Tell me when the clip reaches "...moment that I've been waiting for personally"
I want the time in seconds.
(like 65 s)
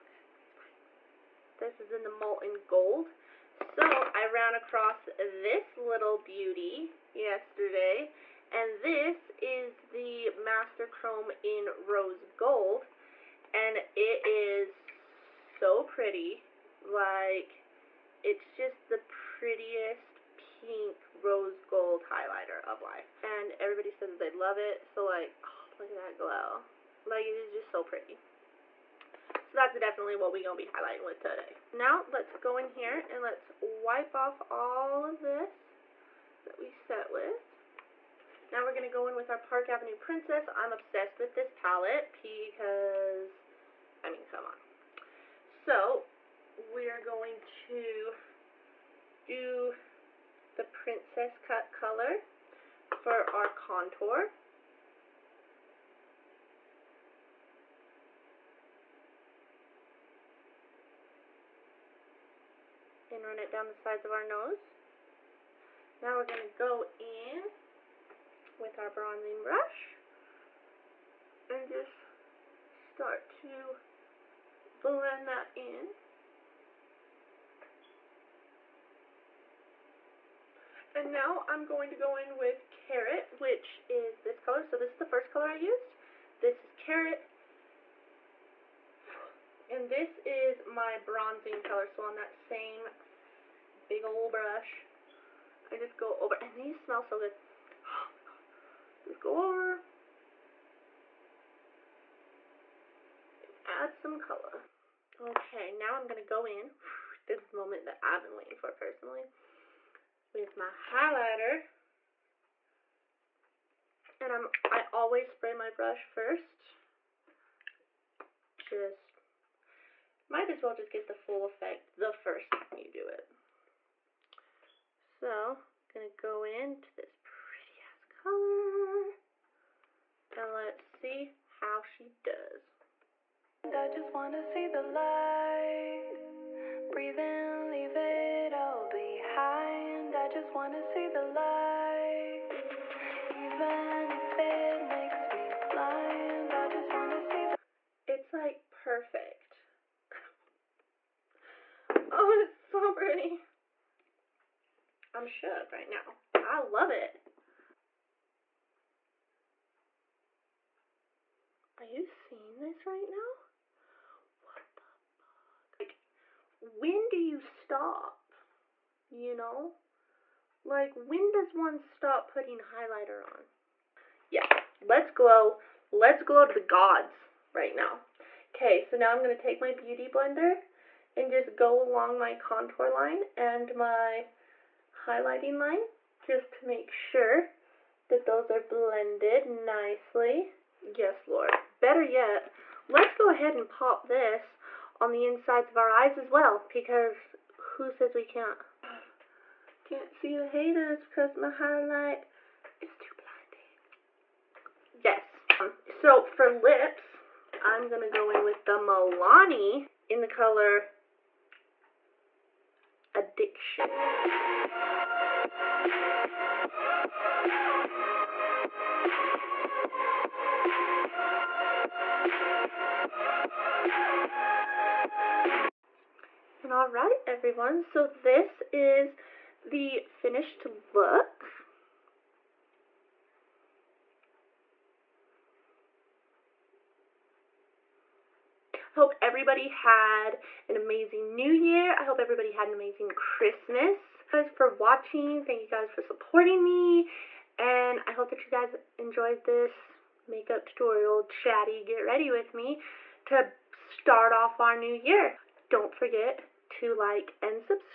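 107 s.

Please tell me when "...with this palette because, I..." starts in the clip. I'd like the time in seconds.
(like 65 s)
41 s.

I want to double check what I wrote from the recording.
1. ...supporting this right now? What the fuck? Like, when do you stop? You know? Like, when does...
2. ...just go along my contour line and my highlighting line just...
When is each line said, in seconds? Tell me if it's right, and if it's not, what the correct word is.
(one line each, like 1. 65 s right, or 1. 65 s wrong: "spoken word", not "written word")
1. 162 s wrong: "seeing", not "supporting"
2. 181 s right.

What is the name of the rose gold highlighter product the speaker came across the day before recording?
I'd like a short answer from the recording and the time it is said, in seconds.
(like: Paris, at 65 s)
Master Chrome, at 10 s.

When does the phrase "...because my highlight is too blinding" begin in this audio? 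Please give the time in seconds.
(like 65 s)
201 s.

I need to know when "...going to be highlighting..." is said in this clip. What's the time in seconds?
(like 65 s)
30 s.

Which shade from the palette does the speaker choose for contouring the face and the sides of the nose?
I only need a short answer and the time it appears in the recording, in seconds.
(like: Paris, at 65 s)
Princess Cut, at 50 s.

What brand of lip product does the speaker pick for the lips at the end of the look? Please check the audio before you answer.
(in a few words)
Milani.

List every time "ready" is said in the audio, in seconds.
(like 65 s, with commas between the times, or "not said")
252 s.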